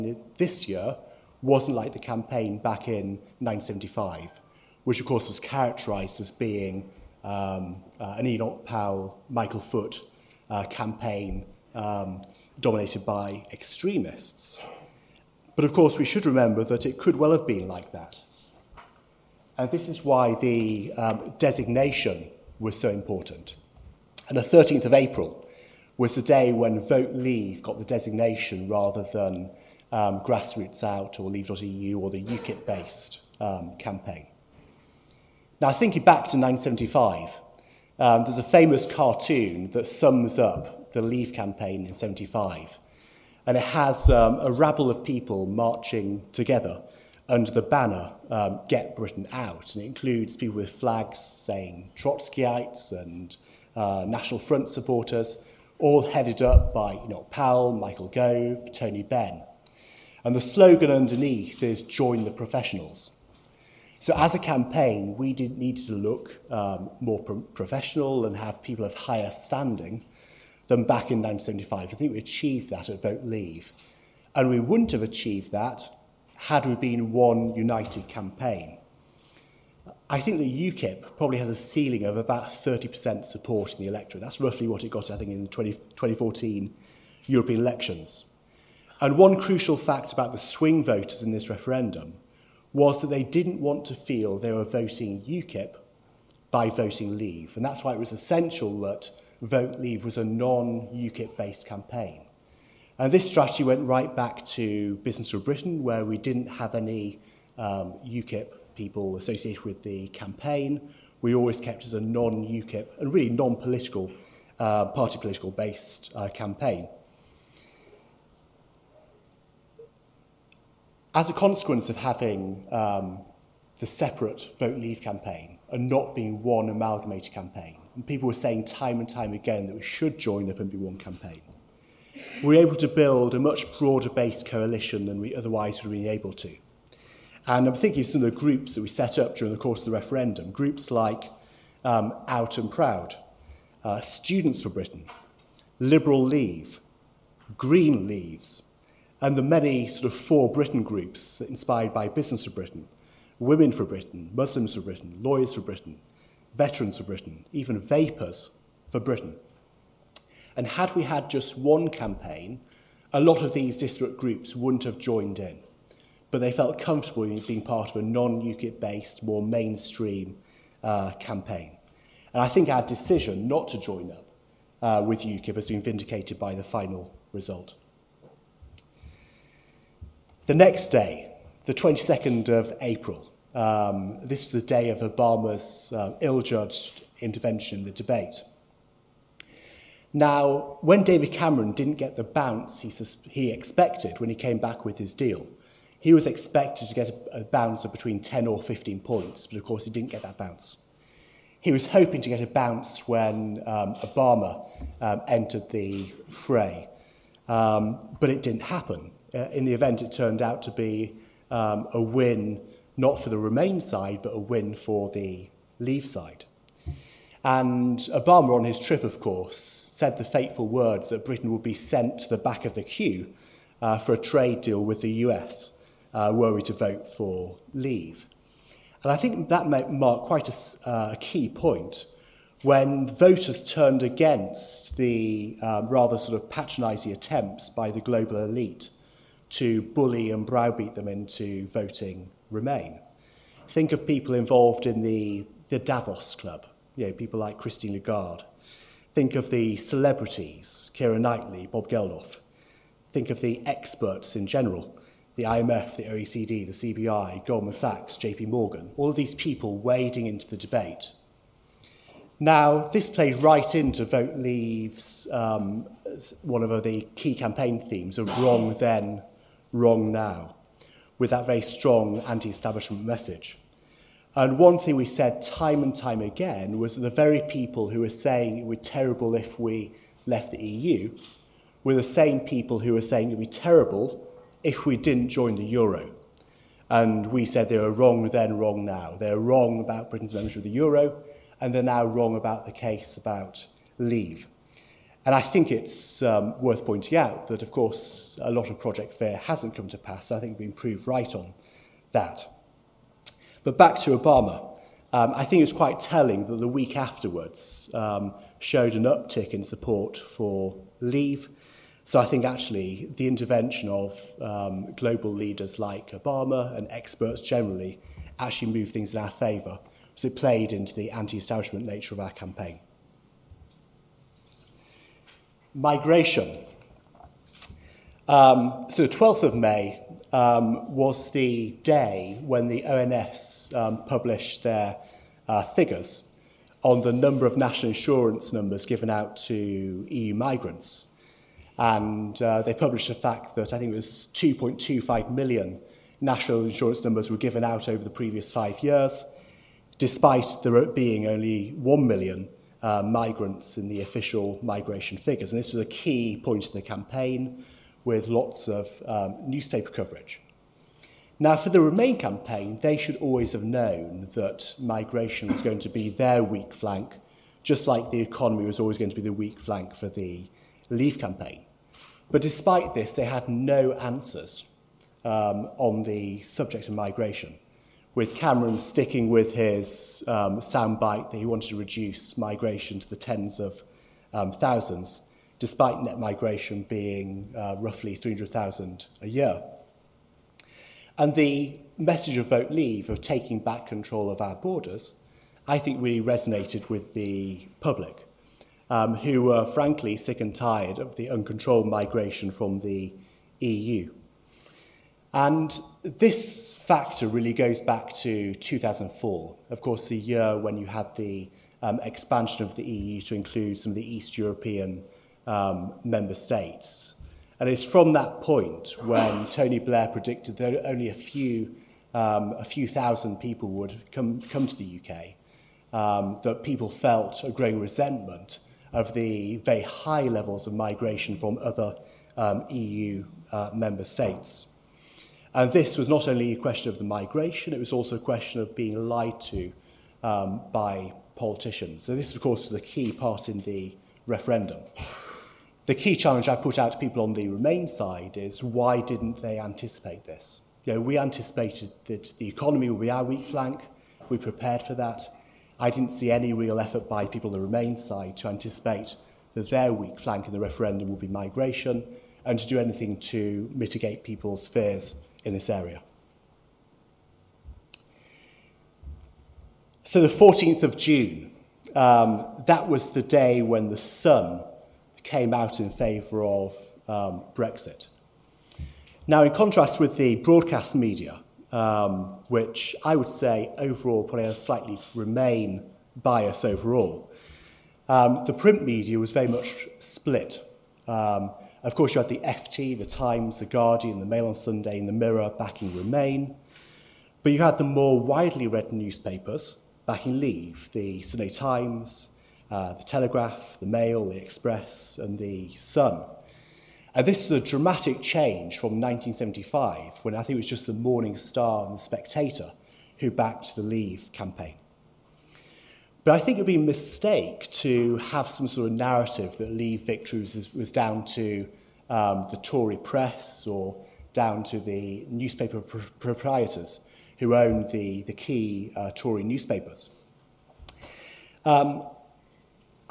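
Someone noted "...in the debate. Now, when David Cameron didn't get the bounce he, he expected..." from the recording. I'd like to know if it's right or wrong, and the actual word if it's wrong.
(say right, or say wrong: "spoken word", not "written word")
right.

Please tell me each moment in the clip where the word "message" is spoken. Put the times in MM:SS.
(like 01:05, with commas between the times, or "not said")
04:33, 06:31.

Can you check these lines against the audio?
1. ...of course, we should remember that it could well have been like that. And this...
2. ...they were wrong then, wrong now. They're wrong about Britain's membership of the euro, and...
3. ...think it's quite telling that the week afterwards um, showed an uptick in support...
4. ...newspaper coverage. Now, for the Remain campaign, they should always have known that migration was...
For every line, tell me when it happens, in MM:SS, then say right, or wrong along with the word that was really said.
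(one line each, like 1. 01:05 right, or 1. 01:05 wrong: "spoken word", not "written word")
1. 00:15 right
2. 04:47 right
3. 05:05 right
4. 05:59 right.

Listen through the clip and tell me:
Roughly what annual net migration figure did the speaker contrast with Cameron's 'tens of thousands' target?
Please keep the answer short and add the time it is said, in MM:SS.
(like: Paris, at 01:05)
300,000, at 06:28.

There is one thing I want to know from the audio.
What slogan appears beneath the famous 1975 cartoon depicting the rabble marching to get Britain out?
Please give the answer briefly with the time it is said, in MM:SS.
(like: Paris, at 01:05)
Join the Professionals, at 01:01.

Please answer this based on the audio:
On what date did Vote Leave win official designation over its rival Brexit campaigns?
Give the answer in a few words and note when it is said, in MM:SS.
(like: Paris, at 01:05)
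13th of April, at 00:24.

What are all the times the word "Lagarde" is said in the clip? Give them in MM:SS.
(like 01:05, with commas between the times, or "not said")
04:07.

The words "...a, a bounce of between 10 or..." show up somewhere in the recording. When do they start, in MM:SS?
03:17.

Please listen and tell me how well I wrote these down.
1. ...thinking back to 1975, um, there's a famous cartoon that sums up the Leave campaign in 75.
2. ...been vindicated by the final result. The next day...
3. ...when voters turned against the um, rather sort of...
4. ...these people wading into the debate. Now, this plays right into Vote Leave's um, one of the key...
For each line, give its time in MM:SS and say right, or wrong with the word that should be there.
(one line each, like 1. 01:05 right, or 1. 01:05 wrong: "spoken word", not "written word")
1. 00:35 right
2. 02:55 right
3. 03:52 right
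4. 04:19 right.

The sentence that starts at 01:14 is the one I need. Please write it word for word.
And we wouldn't have achieved that had we been one united campaign.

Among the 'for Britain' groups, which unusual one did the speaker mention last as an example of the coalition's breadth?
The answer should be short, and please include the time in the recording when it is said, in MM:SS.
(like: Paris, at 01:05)
Vapers for Britain, at 02:37.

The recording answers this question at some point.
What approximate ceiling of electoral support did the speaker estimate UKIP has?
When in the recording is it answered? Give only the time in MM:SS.
01:22.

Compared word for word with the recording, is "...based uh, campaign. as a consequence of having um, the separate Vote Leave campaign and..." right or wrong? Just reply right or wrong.
right.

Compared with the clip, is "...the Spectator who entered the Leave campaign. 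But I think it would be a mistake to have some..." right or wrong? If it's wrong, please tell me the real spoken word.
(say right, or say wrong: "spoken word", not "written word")
wrong: "backed", not "entered".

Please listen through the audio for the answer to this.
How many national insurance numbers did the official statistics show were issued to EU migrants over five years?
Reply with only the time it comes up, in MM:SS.
05:44.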